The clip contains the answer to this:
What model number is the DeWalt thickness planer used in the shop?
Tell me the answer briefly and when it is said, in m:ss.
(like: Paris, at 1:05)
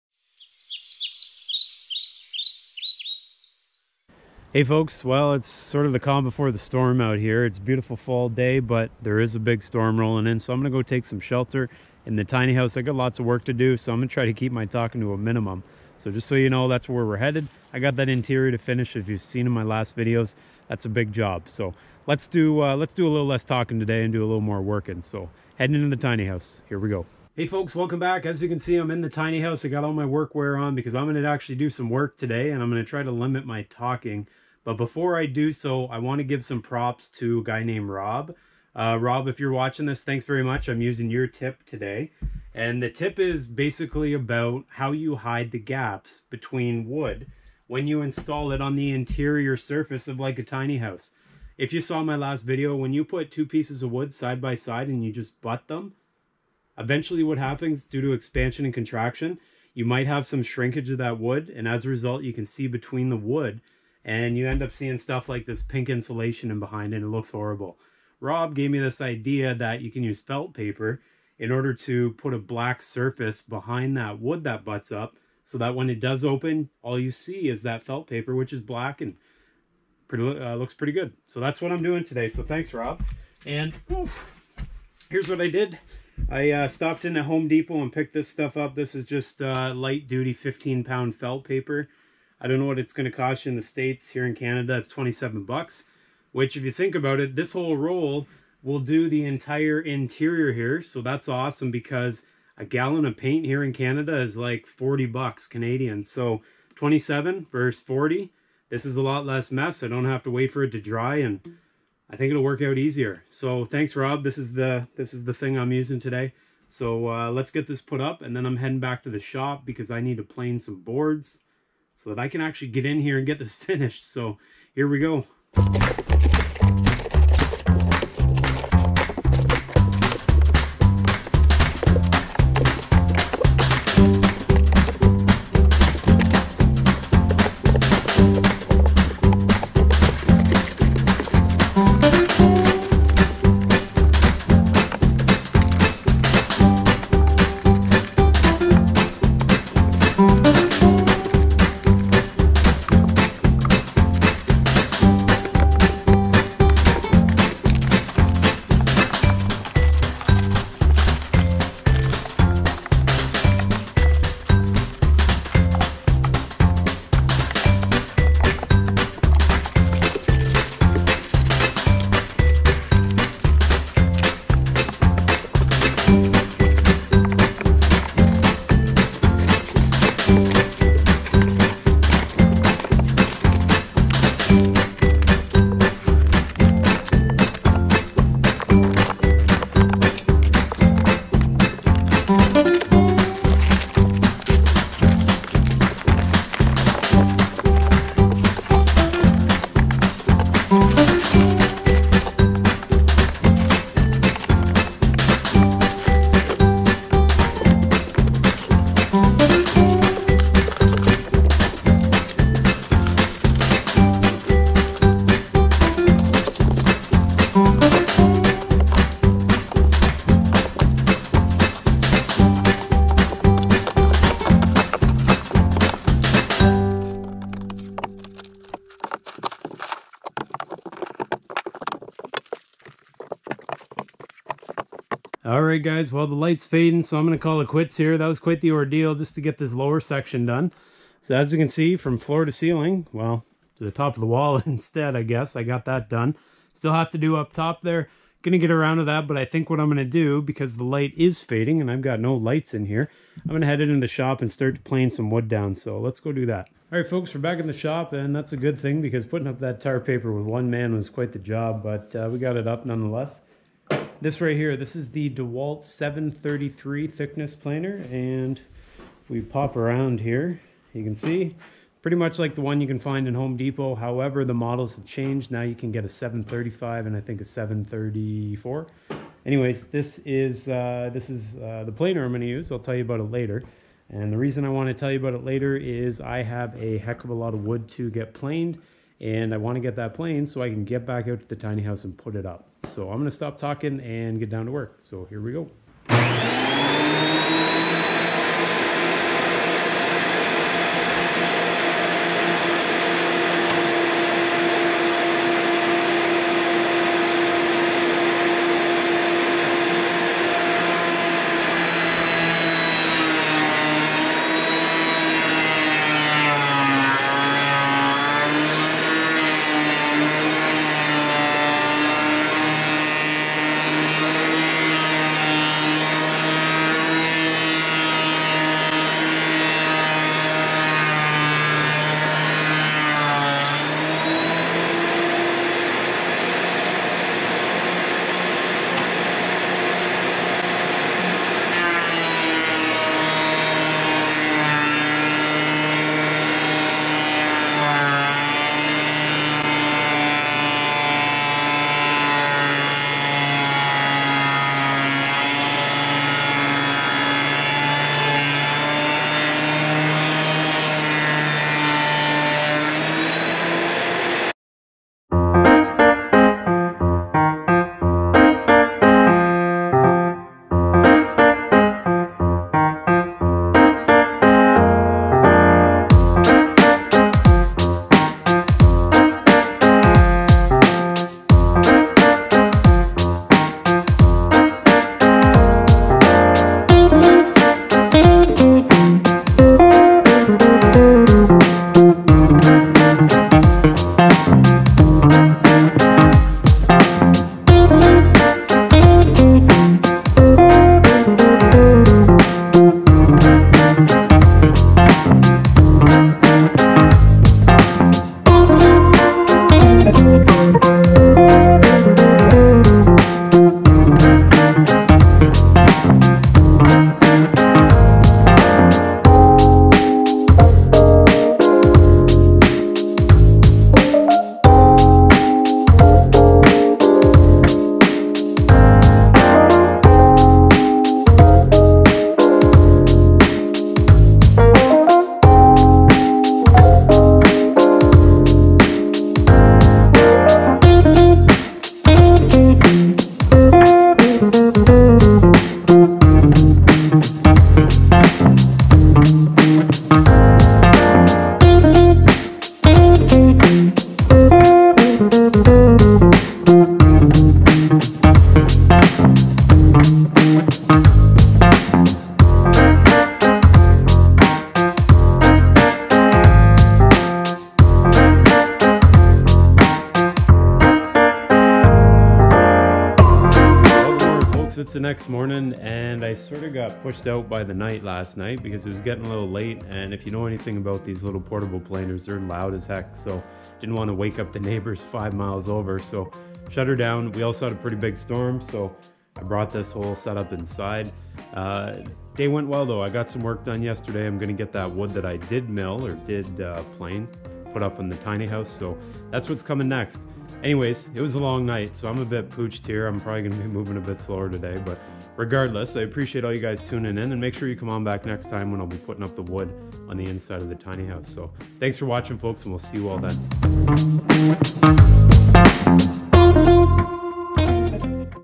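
733, at 4:25.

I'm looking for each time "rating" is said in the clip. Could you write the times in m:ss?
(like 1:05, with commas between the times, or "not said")
not said.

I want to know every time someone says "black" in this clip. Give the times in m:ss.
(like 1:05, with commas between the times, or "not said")
1:12, 1:18.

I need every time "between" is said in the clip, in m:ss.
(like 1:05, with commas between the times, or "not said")
0:46, 1:02.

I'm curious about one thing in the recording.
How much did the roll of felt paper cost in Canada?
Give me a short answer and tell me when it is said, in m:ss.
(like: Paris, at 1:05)
27 bucks, at 1:34.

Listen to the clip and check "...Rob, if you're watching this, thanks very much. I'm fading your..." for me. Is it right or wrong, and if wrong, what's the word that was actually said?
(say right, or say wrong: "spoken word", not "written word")
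wrong: "using", not "fading".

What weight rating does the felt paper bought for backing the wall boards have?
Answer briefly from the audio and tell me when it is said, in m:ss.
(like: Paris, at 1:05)
15 pound, at 1:30.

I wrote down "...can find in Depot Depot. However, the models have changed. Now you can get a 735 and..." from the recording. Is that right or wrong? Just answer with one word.
wrong.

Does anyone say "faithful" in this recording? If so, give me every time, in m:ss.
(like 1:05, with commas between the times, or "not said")
not said.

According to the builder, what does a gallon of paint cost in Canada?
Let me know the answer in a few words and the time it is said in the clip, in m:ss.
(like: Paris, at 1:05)
40 bucks, at 1:44.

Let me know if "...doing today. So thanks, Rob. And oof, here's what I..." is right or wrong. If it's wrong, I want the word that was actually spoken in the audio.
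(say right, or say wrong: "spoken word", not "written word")
right.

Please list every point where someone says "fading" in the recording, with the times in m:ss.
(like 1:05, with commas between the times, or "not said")
3:56, 4:11.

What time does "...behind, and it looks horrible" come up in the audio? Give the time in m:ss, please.
1:06.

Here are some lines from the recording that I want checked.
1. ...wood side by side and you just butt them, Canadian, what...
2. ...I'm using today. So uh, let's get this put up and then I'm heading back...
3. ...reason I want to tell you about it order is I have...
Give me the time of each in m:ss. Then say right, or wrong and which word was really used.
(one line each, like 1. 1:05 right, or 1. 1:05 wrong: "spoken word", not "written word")
1. 0:53 wrong: "Eventually", not "Canadian"
2. 1:55 right
3. 4:44 wrong: "later", not "order".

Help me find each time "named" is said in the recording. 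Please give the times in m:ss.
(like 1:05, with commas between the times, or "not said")
0:37.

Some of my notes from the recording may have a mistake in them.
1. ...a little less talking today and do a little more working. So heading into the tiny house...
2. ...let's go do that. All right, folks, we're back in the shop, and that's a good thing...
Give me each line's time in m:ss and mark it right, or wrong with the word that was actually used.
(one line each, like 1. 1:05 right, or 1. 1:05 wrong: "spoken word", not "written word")
1. 0:23 right
2. 4:16 right.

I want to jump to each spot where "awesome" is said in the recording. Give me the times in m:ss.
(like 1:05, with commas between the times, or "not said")
1:41.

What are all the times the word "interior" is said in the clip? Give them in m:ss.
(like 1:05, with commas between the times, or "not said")
0:18, 0:48, 1:39.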